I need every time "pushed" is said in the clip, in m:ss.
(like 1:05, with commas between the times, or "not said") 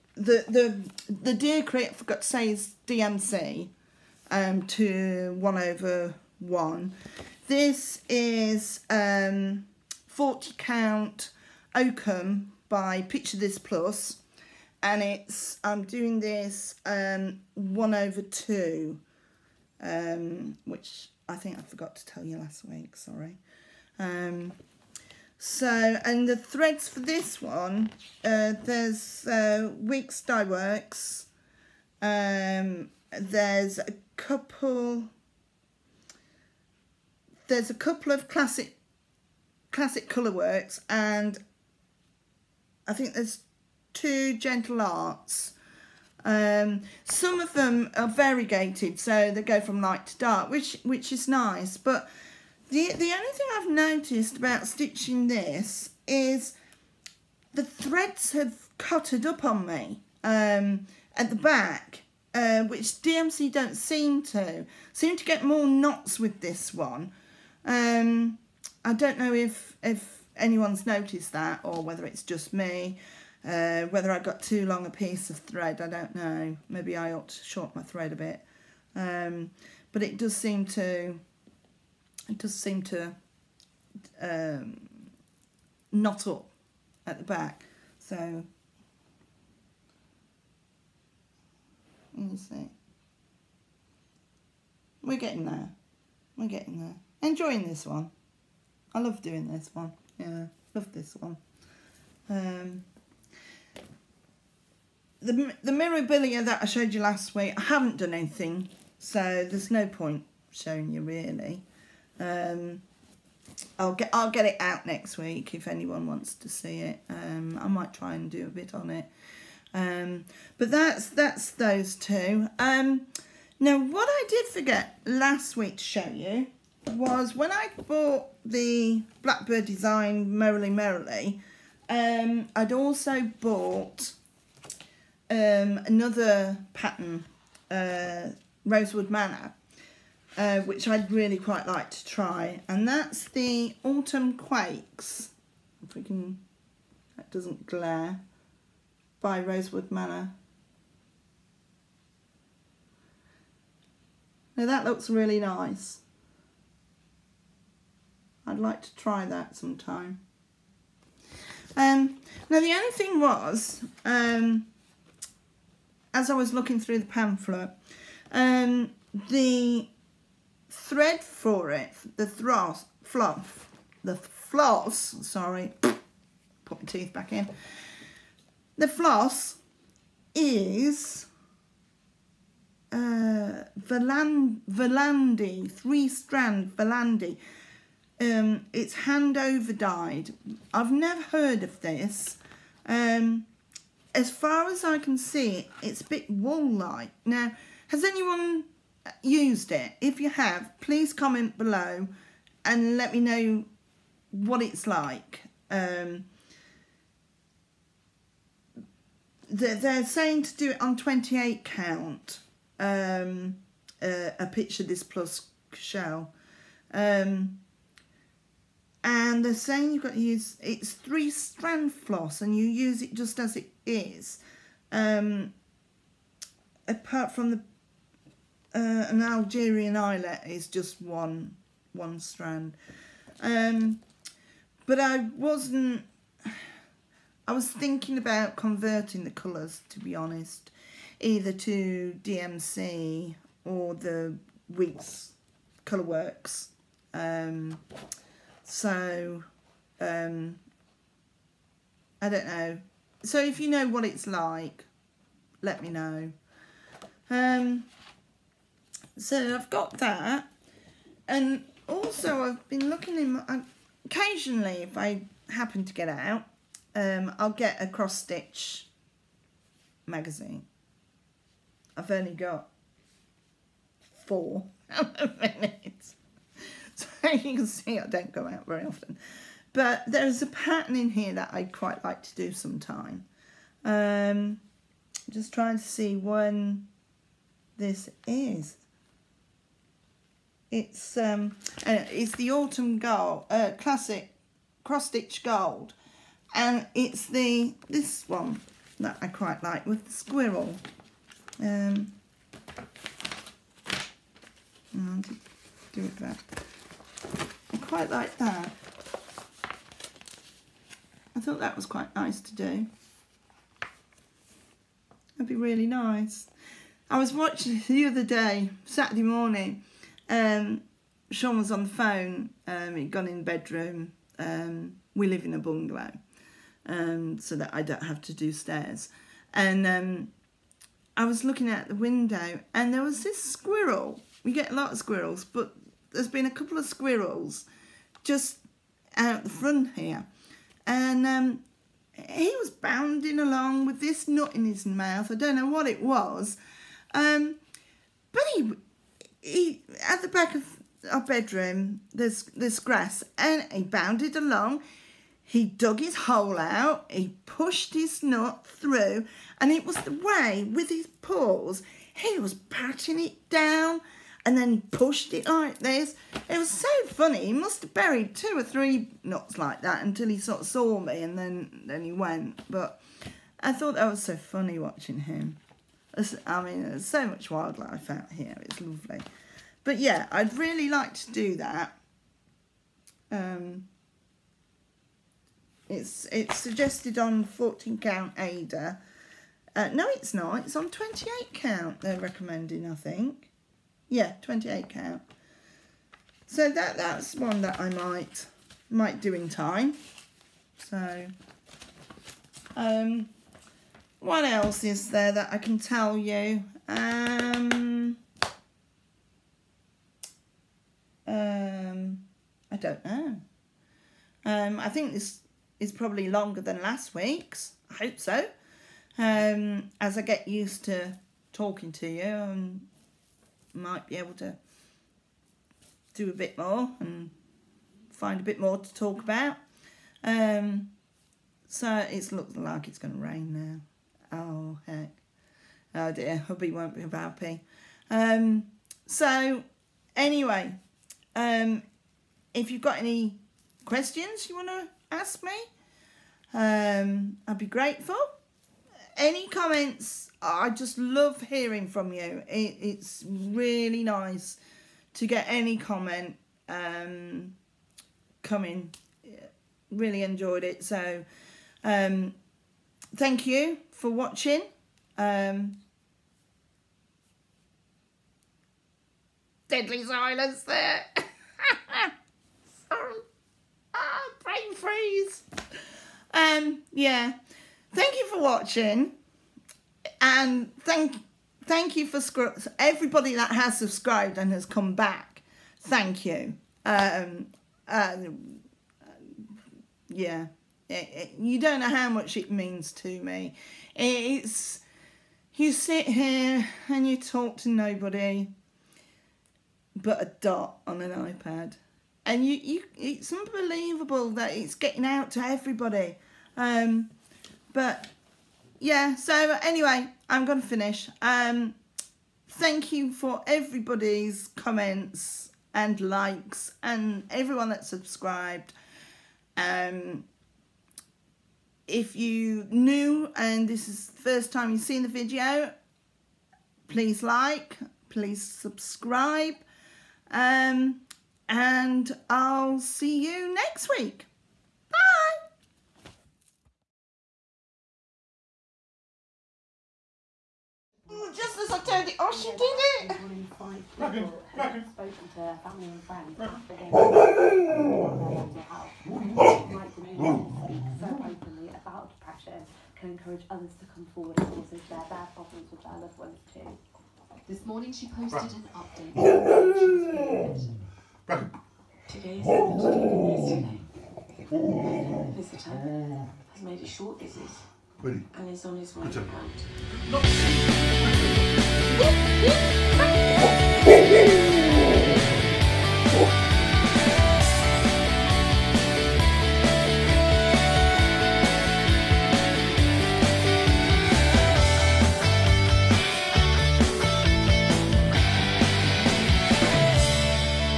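5:57, 6:04.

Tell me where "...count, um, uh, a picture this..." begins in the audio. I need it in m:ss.
3:31.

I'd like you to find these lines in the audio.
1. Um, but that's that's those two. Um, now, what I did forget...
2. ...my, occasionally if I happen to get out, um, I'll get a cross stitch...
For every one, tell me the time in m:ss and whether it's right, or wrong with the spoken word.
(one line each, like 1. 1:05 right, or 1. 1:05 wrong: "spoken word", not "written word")
1. 1:59 right
2. 4:23 right.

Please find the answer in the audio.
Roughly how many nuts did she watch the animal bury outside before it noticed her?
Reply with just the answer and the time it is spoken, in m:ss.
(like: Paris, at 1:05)
2 or 3, at 6:08.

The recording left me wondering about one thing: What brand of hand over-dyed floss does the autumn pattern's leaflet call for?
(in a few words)
Valdani.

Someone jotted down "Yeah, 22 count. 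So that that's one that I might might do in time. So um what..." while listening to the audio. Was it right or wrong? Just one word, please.
wrong.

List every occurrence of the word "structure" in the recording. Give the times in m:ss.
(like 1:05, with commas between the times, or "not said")
not said.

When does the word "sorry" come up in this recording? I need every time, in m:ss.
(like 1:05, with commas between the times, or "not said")
0:22, 2:55, 7:52.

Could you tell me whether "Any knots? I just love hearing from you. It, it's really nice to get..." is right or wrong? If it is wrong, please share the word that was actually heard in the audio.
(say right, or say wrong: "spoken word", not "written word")
wrong: "comments", not "knots".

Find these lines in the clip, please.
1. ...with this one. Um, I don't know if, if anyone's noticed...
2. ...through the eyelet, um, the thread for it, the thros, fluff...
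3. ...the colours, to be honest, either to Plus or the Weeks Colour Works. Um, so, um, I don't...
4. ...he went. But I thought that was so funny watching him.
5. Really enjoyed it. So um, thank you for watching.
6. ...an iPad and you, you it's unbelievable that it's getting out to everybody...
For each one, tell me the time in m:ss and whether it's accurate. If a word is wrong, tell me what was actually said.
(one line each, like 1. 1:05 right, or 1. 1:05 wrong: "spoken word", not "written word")
1. 1:06 right
2. 2:46 wrong: "pamphlet", not "eyelet"
3. 3:59 wrong: "DMC", not "Plus"
4. 6:12 right
5. 7:39 right
6. 8:21 right.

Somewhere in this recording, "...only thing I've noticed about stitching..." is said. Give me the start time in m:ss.
0:53.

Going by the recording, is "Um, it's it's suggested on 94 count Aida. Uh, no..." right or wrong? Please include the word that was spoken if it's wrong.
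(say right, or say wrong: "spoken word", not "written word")
wrong: "14", not "94".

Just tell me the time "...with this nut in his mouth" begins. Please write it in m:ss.
5:43.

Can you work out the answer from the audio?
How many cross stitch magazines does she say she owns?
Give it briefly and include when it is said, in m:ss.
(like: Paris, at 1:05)
4, at 4:34.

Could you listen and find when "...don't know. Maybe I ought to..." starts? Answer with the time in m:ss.
1:15.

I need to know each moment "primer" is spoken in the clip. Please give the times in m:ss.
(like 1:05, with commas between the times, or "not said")
not said.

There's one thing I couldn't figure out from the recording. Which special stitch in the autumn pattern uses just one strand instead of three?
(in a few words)
Algerian eyelet.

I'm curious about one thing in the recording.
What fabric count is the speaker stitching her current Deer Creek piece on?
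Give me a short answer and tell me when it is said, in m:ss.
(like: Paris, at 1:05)
40 count, at 0:10.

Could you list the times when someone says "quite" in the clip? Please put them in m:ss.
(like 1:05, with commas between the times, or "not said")
2:21, 4:41, 4:59, 5:07, 5:11.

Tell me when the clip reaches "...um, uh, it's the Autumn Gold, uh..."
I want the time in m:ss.
4:51.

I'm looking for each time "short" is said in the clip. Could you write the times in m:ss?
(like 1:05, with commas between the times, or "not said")
1:17, 9:26.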